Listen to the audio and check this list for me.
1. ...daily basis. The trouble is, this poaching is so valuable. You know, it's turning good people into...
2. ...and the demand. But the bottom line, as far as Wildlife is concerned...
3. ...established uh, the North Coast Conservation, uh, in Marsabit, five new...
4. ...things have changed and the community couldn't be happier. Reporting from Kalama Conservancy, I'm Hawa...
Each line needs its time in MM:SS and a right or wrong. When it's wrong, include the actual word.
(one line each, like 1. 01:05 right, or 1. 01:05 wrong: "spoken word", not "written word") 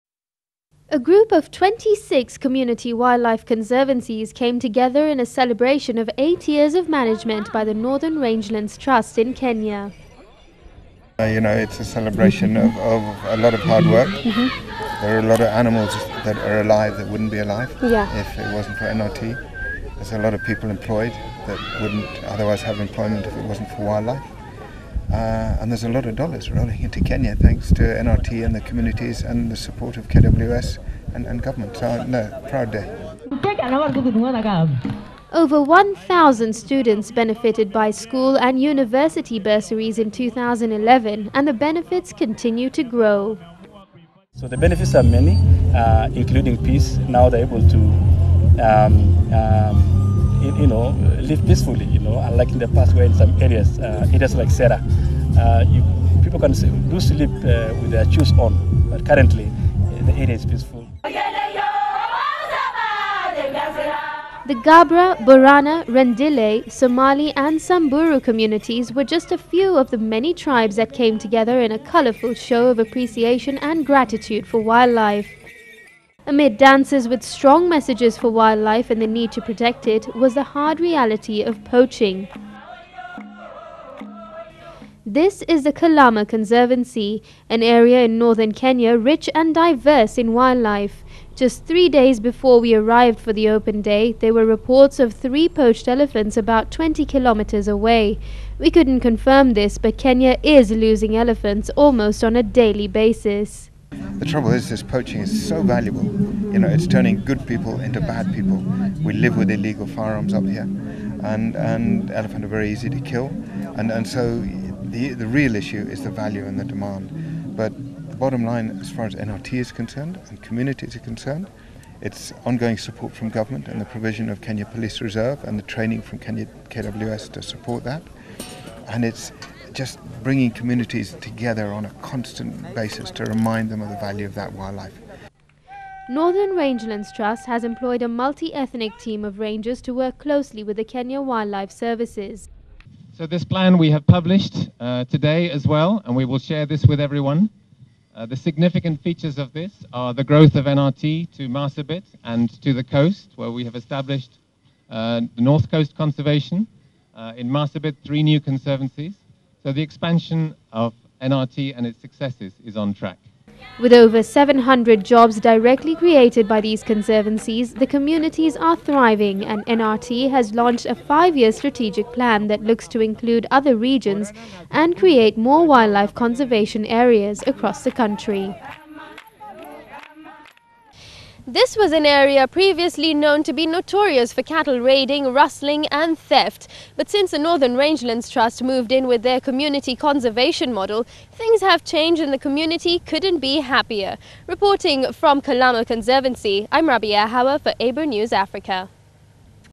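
1. 01:42 right
2. 01:56 wrong: "NRT", not "Wildlife"
3. 02:33 wrong: "three", not "five"
4. 03:11 wrong: "Raabia", not "Hawa".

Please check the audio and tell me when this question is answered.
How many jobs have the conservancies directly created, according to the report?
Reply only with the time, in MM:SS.
02:43.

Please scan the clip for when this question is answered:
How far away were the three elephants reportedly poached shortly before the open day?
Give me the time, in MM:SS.
01:36.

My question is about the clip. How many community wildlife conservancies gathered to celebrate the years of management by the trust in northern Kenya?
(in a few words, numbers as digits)
26.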